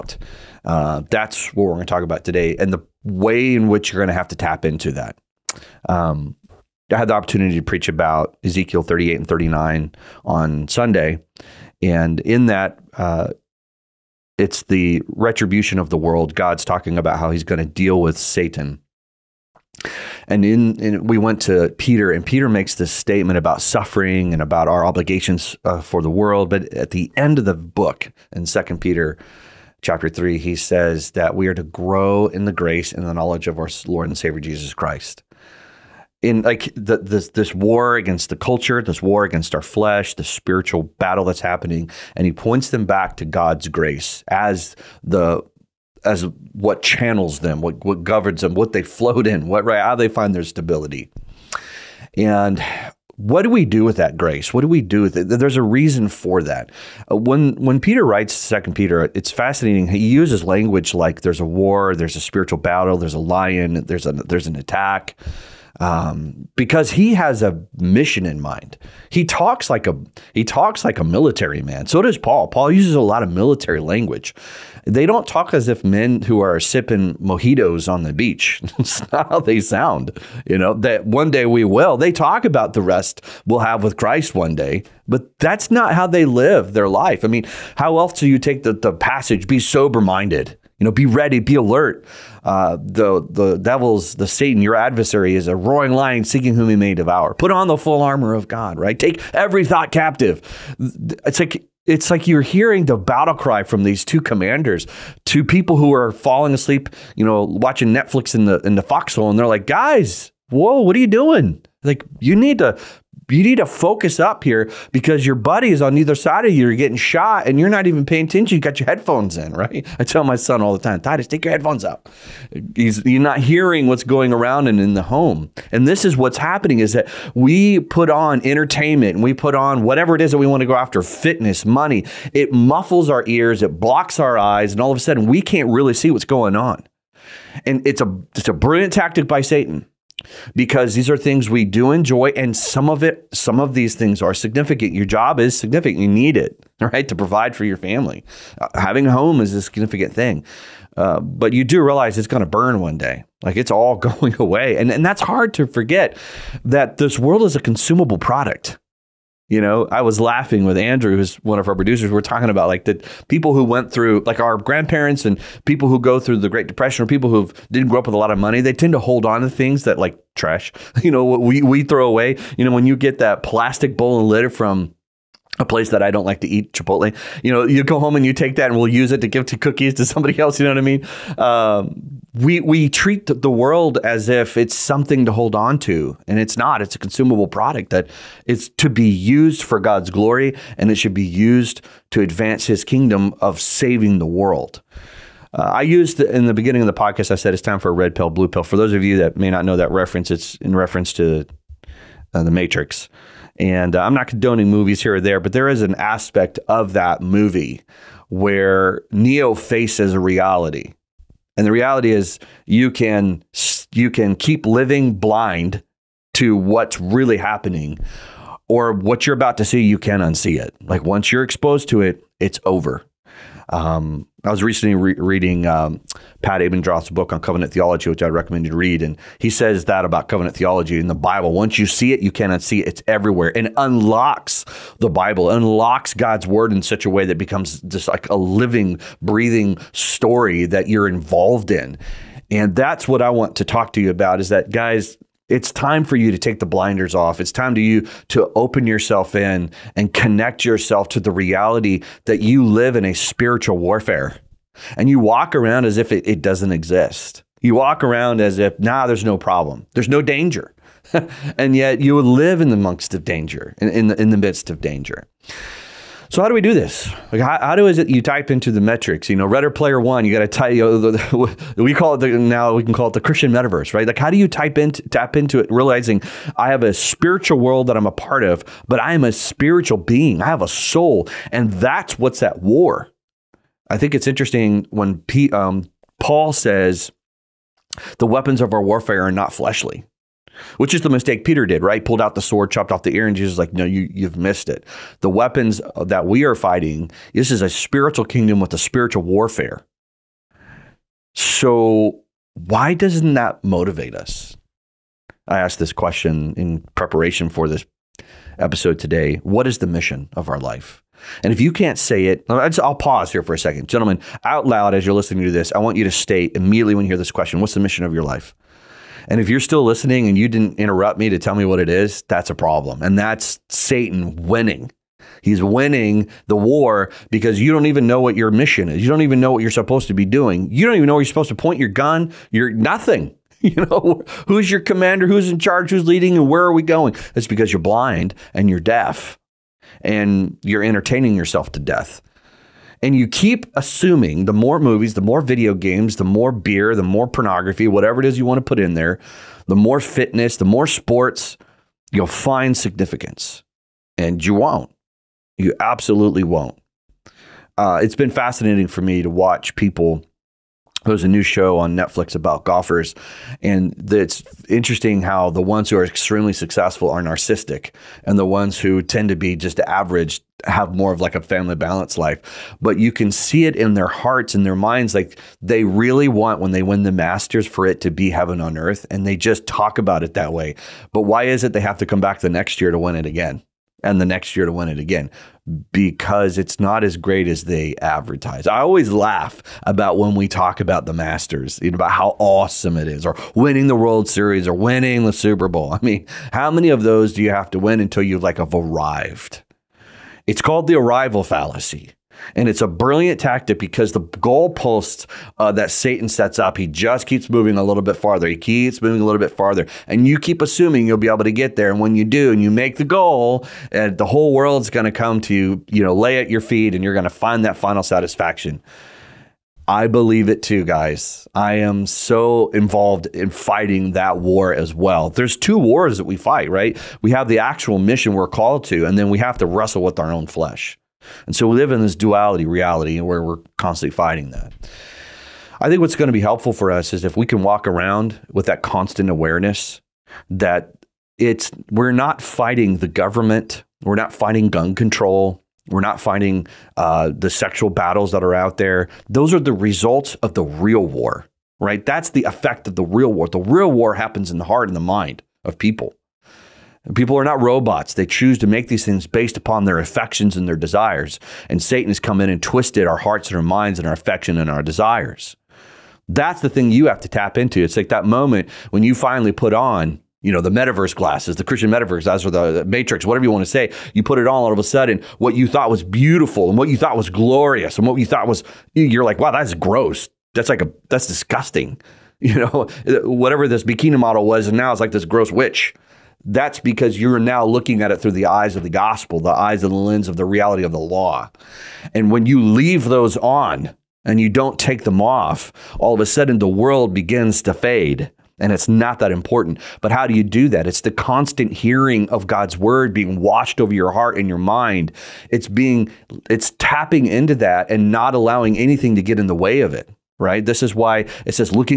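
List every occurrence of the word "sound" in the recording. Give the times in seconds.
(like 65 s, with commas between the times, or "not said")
79 s.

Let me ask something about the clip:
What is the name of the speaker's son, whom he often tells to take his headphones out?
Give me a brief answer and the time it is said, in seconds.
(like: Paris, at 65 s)
Titus, at 121 s.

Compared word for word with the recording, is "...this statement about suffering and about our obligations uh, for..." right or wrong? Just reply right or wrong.
right.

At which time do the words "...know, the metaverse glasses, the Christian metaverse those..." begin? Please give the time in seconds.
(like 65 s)
470 s.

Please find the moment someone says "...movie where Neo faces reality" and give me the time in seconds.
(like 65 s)
207 s.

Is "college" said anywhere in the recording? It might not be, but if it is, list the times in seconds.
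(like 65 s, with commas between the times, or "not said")
not said.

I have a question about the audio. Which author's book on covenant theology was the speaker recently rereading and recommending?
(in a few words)
Pat Abendroth.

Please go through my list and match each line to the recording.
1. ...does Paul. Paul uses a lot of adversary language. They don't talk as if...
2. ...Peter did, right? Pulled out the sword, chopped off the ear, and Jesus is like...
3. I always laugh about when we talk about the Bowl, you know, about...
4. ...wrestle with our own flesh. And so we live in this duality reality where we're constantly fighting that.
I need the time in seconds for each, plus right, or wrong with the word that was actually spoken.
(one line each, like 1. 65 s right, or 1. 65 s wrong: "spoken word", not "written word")
1. 72 s wrong: "military", not "adversary"
2. 291 s right
3. 388 s wrong: "Masters", not "Bowl"
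4. 429 s right.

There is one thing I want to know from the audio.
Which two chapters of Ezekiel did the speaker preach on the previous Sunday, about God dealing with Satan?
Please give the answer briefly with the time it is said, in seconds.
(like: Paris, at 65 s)
38 and 39, at 8 s.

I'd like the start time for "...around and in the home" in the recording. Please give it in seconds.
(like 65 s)
124 s.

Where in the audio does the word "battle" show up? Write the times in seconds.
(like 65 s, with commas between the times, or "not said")
40 s, 62 s, 102 s, 447 s.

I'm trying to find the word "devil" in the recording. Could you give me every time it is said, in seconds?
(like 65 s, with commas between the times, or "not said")
93 s.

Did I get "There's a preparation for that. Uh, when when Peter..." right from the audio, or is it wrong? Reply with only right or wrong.
wrong.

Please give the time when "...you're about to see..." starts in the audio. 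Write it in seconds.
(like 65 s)
219 s.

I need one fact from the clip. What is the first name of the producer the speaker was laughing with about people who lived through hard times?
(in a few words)
Andrew.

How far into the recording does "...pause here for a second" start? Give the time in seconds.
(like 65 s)
312 s.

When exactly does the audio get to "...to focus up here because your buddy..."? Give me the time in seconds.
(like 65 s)
113 s.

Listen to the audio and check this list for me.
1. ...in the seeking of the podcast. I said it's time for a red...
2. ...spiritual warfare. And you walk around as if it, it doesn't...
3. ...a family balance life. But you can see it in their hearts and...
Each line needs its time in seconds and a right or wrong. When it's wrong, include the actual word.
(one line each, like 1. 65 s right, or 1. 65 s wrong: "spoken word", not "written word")
1. 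196 s wrong: "beginning", not "seeking"
2. 253 s right
3. 371 s right.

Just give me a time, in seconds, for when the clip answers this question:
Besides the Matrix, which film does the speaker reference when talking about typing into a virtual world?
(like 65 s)
269 s.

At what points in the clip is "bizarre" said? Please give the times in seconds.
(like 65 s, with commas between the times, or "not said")
not said.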